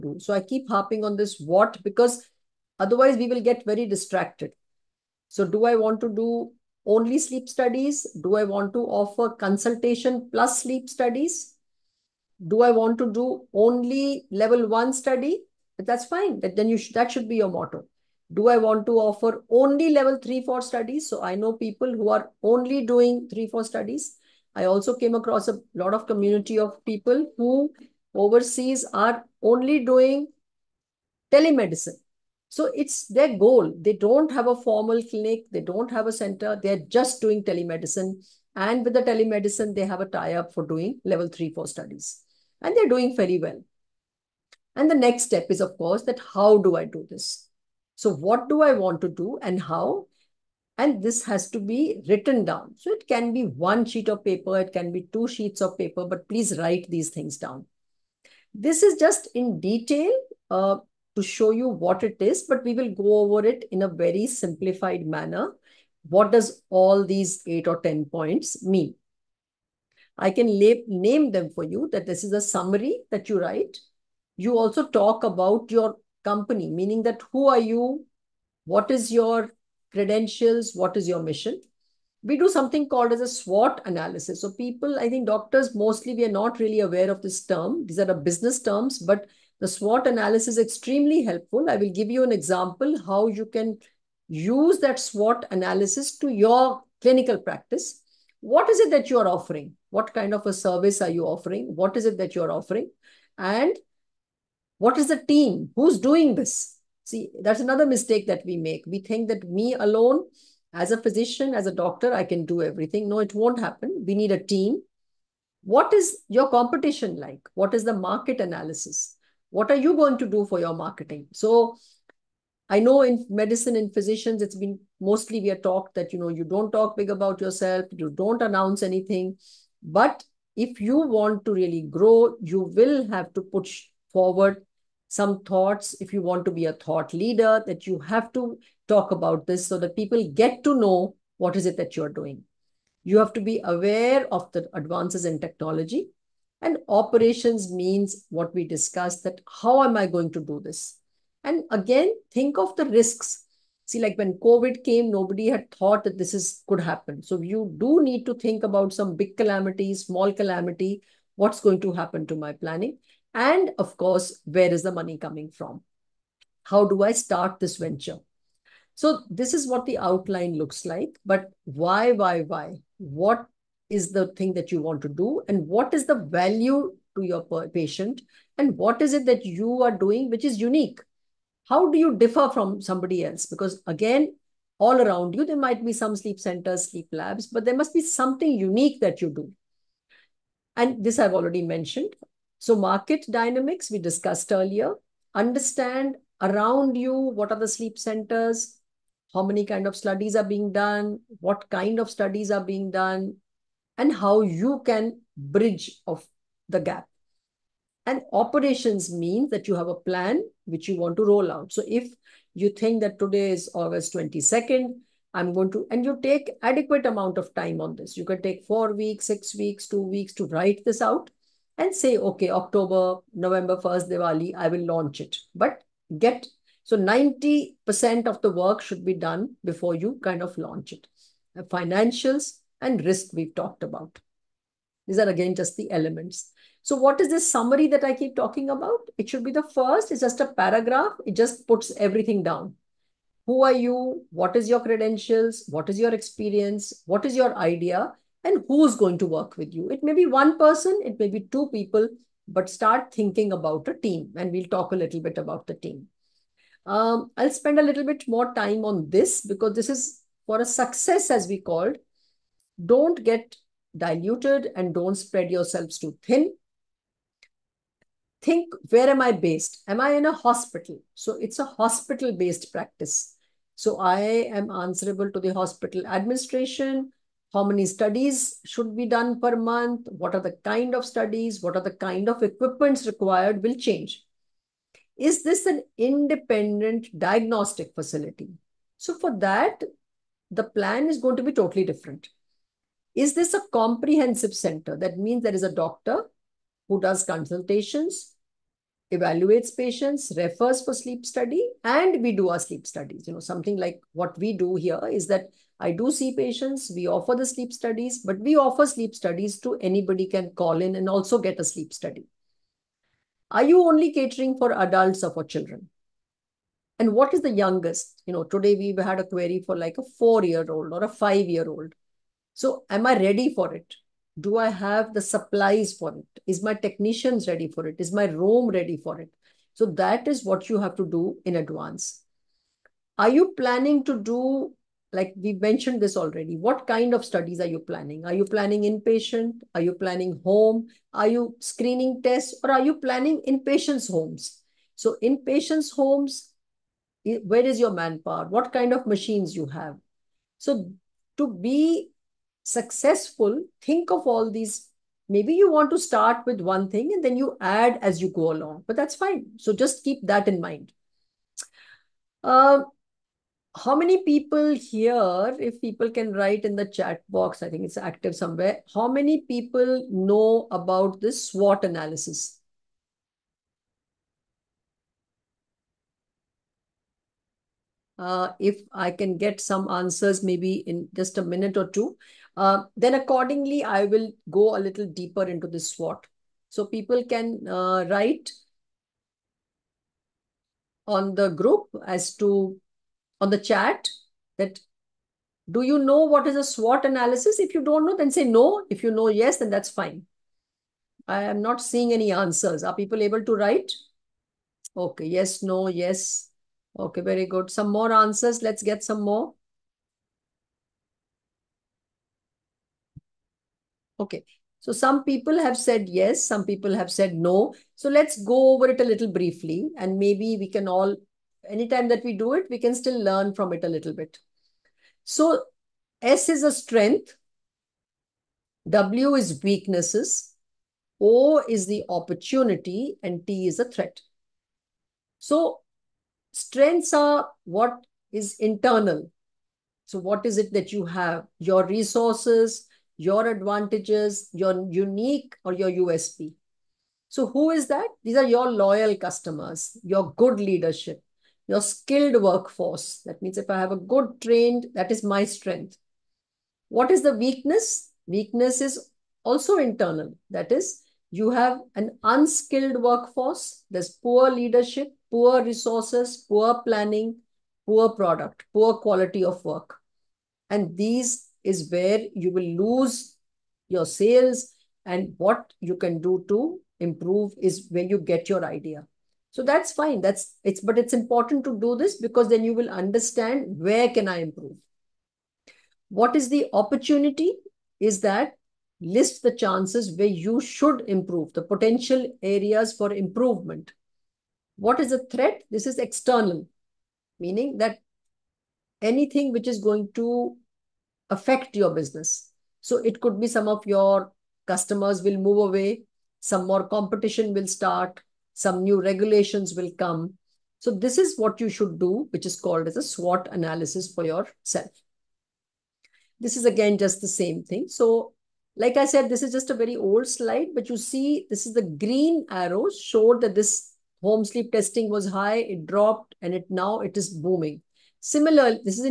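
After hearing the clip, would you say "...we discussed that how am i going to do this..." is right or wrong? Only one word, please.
right.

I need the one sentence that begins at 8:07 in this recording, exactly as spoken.
Is that list the chances where you should improve, the potential areas for improvement.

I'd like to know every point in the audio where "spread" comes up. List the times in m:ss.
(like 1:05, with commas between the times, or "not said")
4:25.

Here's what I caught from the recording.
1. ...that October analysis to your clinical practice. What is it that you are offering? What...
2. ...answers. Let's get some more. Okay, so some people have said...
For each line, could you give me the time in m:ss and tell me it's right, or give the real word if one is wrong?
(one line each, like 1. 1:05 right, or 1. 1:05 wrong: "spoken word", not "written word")
1. 1:34 wrong: "SWOT", not "October"
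2. 6:48 right.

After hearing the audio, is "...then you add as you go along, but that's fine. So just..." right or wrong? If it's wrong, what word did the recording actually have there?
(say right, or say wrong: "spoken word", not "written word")
right.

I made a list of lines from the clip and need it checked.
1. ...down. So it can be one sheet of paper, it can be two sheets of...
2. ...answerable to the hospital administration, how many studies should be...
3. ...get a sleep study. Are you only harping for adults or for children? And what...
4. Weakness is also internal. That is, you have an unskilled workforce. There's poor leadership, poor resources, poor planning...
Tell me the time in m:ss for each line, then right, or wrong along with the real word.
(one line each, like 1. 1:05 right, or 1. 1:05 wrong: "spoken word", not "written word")
1. 0:52 right
2. 4:34 right
3. 5:11 wrong: "catering", not "harping"
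4. 7:38 right.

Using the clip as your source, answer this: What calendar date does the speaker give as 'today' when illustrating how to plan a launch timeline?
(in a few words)
August 22nd.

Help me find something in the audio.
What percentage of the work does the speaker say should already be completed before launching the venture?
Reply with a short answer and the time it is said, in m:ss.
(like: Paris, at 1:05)
90%, at 3:46.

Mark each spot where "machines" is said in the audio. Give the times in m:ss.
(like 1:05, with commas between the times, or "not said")
5:49.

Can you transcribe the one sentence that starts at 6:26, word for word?
So people can uh, write on the group as to on the chat that do you know what is a SWOT analysis?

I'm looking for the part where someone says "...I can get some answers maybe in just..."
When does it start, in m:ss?
6:18.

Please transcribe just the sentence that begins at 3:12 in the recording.
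So market dynamics, we discussed earlier.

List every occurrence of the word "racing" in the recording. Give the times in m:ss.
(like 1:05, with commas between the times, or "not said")
not said.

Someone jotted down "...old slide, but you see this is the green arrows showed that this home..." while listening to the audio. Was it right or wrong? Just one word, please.
right.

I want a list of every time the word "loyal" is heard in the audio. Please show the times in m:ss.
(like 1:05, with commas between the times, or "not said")
7:28.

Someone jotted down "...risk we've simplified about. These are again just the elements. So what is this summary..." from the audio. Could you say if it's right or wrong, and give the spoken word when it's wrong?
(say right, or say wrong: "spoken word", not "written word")
wrong: "talked", not "simplified".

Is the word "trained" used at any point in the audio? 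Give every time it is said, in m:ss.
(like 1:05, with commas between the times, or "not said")
7:34.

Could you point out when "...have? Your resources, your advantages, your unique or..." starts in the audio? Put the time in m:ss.
7:21.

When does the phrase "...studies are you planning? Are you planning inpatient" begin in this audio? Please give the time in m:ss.
5:37.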